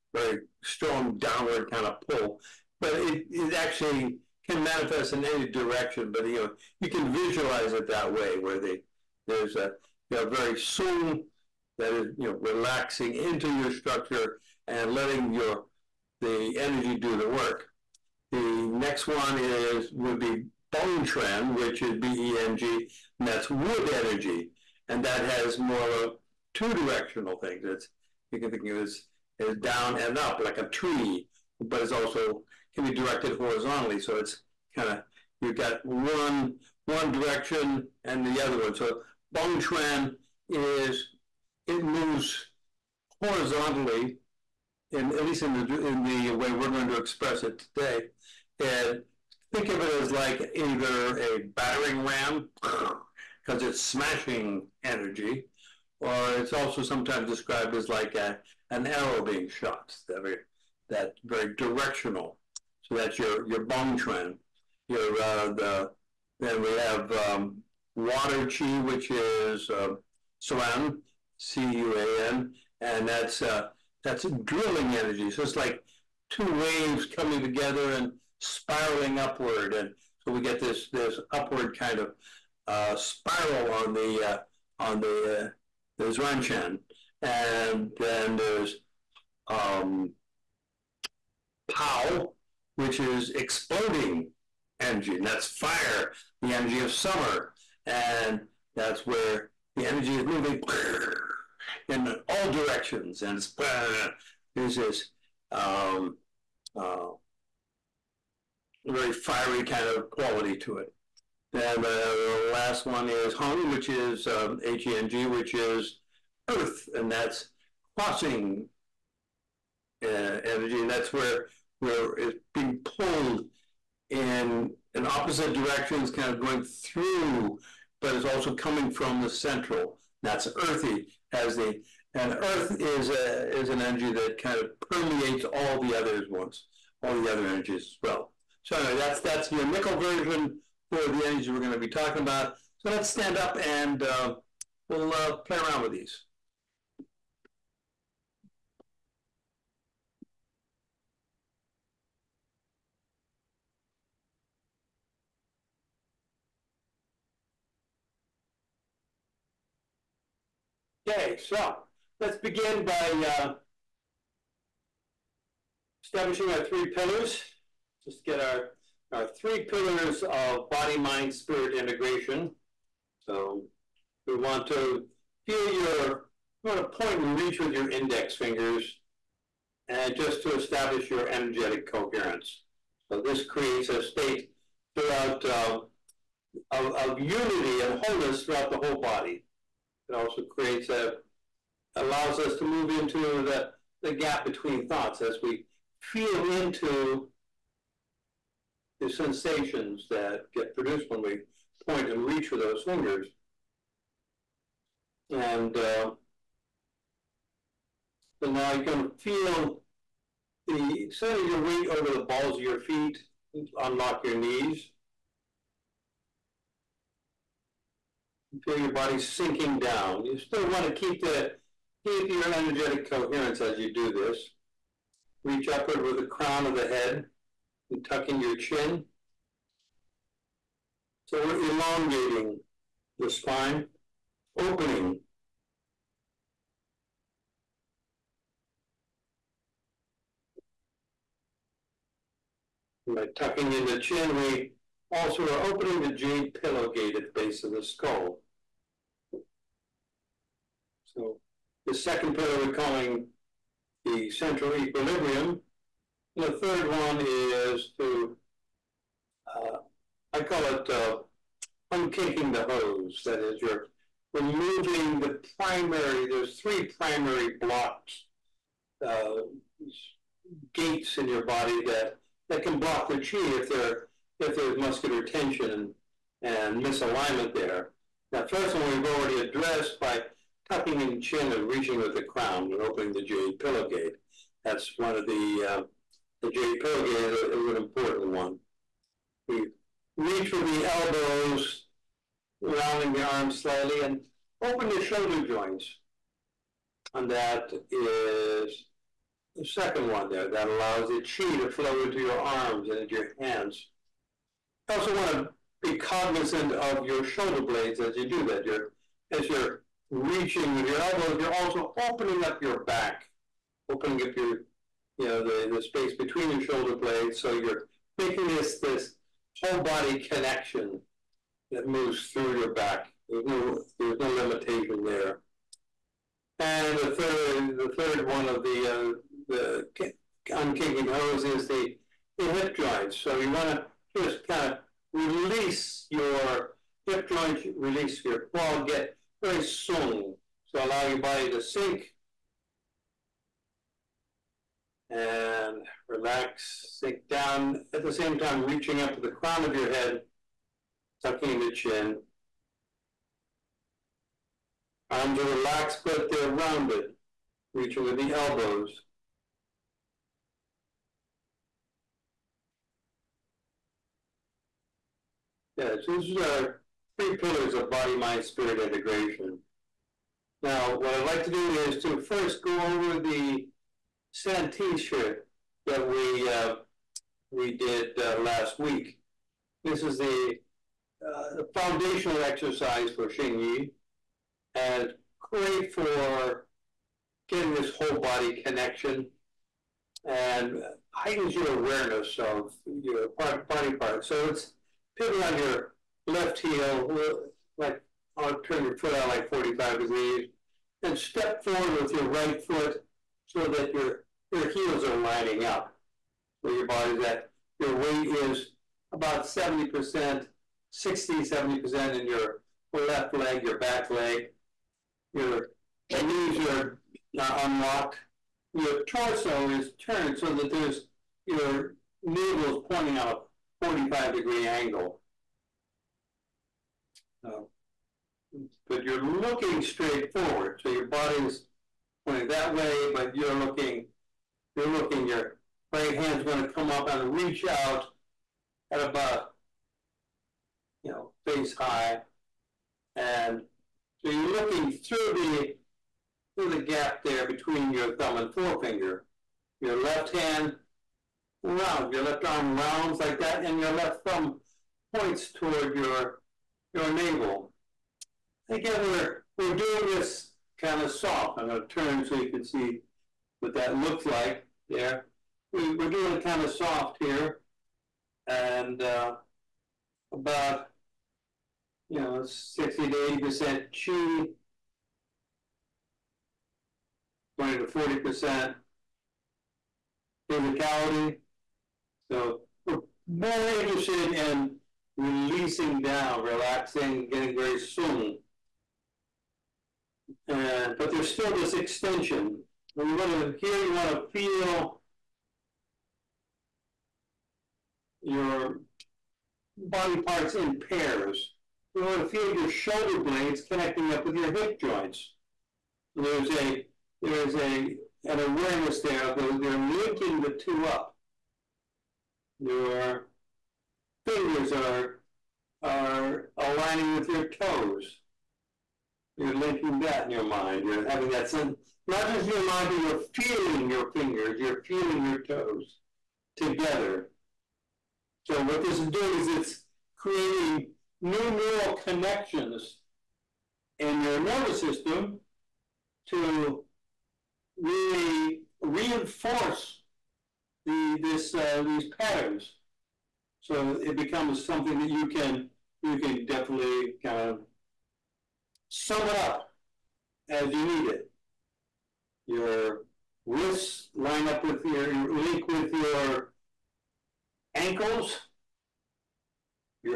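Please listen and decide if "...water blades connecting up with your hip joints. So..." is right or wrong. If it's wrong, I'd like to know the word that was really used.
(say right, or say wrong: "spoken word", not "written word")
wrong: "shoulder", not "water".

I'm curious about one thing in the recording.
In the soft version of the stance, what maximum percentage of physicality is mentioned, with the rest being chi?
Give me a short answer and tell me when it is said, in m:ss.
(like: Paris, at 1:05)
40%, at 7:57.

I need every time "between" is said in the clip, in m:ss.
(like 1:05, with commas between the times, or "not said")
3:14, 5:16, 7:27.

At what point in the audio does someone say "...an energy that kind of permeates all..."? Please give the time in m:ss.
2:13.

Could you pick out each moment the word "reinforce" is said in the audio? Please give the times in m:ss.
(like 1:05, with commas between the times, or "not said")
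8:58.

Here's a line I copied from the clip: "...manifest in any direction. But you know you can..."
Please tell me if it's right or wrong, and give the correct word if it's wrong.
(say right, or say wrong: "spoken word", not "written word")
right.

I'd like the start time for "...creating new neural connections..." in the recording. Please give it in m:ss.
8:50.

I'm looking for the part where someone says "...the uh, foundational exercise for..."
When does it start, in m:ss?
6:20.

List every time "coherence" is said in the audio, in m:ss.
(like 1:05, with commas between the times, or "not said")
3:01, 3:43.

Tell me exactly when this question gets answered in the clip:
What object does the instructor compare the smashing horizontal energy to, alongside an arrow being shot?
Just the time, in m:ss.
0:51.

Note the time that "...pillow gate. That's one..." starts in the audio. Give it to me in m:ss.
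4:43.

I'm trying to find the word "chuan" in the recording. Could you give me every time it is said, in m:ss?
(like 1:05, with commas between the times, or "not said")
0:39, 1:03.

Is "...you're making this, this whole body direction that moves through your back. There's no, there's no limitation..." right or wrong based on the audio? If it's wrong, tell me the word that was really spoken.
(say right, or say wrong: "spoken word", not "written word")
wrong: "connection", not "direction".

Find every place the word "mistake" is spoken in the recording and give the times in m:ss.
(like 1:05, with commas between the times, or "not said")
not said.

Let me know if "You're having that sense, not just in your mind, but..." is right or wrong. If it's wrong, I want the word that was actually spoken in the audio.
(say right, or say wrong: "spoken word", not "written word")
right.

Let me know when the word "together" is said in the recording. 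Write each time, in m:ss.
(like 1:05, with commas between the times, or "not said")
1:17, 8:46.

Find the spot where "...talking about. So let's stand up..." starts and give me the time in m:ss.
2:21.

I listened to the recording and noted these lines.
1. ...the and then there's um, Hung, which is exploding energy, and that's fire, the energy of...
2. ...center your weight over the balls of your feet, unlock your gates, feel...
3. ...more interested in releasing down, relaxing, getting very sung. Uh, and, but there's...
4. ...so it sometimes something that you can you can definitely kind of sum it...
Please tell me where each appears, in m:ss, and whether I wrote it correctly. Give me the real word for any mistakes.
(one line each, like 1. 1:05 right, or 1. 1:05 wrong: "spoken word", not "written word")
1. 1:25 wrong: "Pao", not "Hung"
2. 3:31 wrong: "knees", not "gates"
3. 8:03 right
4. 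9:03 wrong: "becomes", not "sometimes".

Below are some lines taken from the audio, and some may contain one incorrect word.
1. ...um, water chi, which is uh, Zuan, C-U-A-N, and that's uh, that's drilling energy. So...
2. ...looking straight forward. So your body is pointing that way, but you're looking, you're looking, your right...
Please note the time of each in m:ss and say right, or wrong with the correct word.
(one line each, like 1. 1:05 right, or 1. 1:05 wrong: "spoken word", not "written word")
1. 1:07 right
2. 7:09 right.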